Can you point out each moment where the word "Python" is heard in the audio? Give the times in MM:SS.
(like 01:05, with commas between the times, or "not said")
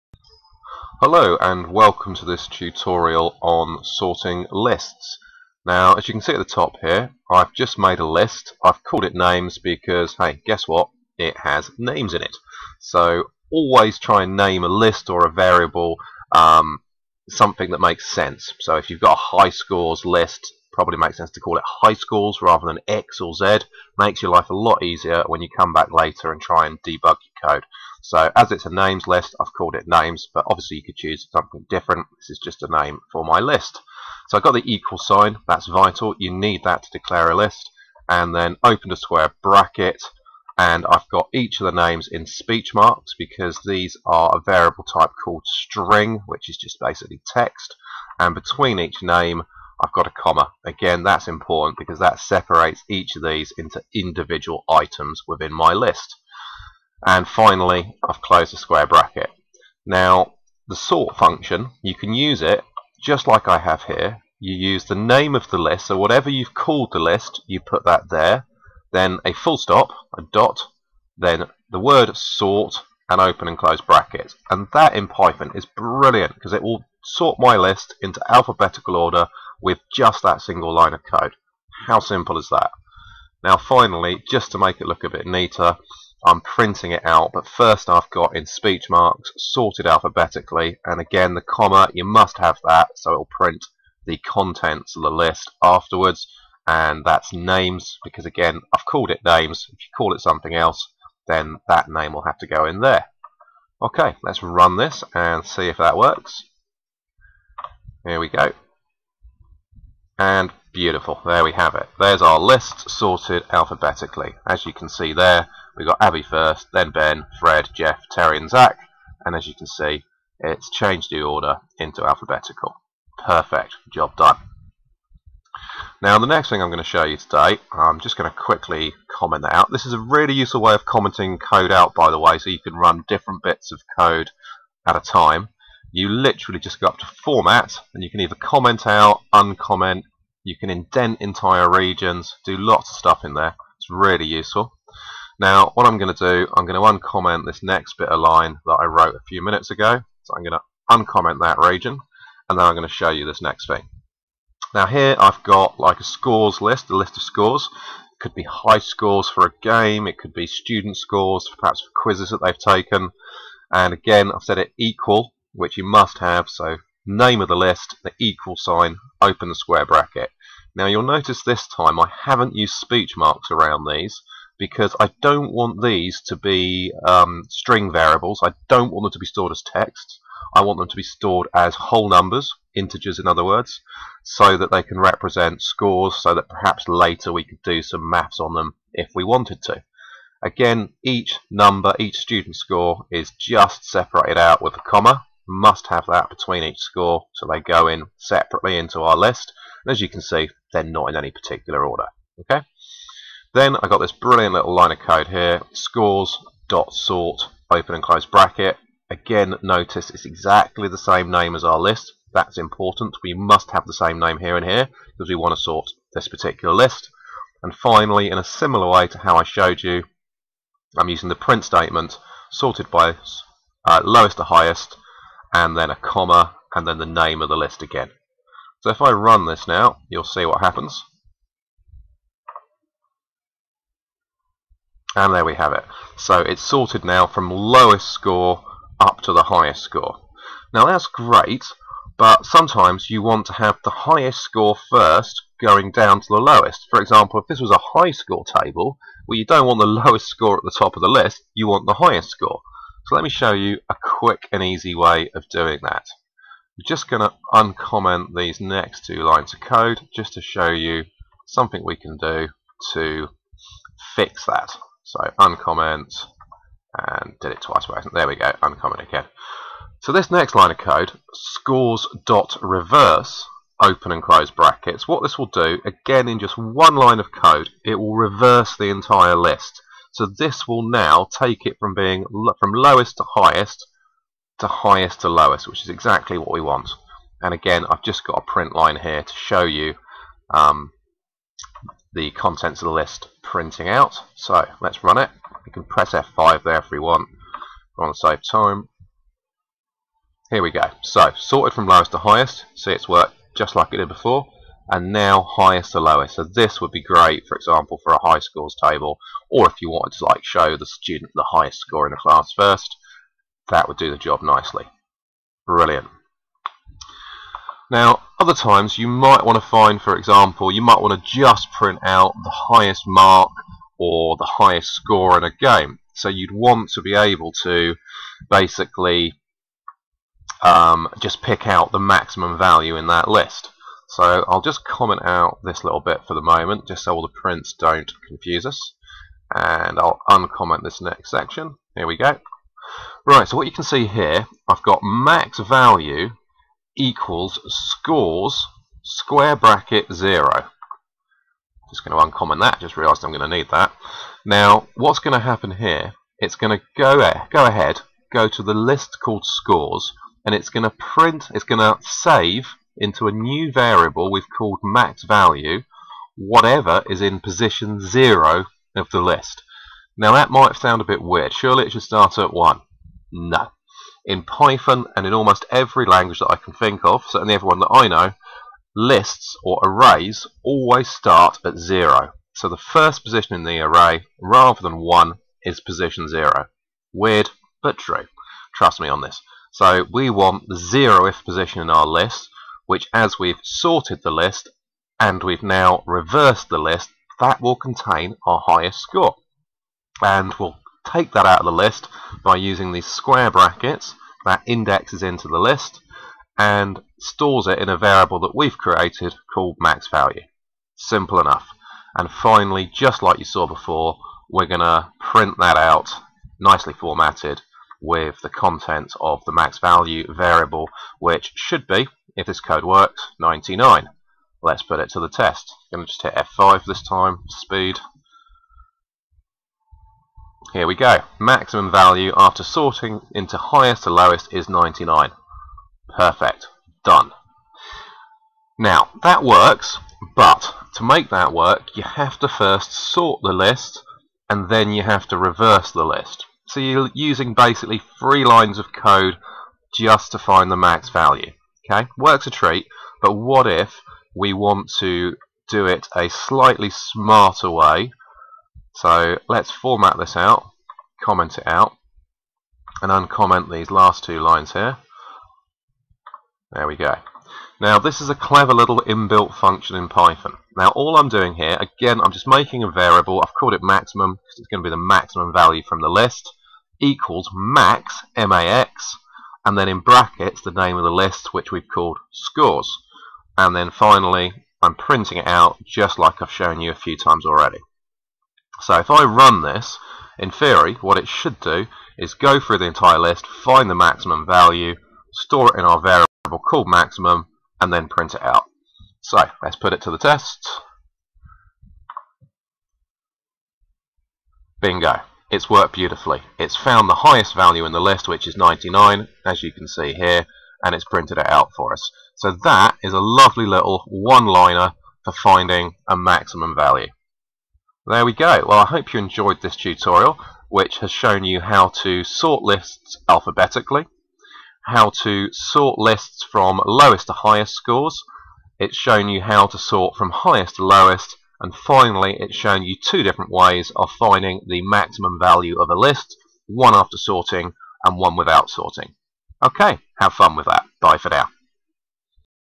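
01:15, 06:14, 07:50.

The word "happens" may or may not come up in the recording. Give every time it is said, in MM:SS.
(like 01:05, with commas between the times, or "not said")
03:50, 05:55.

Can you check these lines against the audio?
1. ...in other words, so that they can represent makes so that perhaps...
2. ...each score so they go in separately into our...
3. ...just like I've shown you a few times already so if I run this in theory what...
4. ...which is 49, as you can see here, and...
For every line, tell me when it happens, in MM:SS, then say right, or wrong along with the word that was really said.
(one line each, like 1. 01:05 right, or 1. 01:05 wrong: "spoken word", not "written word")
1. 03:03 wrong: "scores", not "makes"
2. 03:16 right
3. 08:05 right
4. 08:28 wrong: "99", not "49".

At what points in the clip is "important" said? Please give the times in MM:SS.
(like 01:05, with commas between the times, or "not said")
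00:51, 03:32.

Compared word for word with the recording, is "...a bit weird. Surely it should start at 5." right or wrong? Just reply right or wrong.
wrong.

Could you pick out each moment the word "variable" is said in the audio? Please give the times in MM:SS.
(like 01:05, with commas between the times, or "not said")
00:15, 00:44, 02:57, 06:03, 06:47, 07:00, 07:52, 08:16.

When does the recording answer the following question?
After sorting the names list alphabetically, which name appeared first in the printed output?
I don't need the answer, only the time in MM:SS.
01:56.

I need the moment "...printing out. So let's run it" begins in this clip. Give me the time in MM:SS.
04:53.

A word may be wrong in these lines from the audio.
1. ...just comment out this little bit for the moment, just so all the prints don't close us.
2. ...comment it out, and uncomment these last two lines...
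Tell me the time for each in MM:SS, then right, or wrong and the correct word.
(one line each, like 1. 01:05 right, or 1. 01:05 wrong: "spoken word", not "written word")
1. 05:34 wrong: "confuse", not "close"
2. 07:41 right.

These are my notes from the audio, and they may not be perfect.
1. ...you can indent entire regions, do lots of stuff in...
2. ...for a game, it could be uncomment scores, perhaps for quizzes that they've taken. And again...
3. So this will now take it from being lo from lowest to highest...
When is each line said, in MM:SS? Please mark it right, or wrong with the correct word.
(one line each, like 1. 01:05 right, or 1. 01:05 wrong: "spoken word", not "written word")
1. 02:20 right
2. 02:39 wrong: "student", not "uncomment"
3. 04:40 right.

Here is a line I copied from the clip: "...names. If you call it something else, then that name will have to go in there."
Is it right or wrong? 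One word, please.
right.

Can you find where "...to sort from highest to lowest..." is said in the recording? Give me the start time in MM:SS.
08:49.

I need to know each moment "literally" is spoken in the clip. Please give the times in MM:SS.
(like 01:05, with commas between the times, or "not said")
02:16.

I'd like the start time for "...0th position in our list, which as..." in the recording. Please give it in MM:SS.
06:30.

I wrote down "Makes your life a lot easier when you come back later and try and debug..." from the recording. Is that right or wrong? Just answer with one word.
right.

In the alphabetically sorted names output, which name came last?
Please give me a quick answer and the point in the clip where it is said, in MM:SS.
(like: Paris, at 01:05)
Zach, at 01:58.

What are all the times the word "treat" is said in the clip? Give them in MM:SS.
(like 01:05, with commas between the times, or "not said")
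07:32.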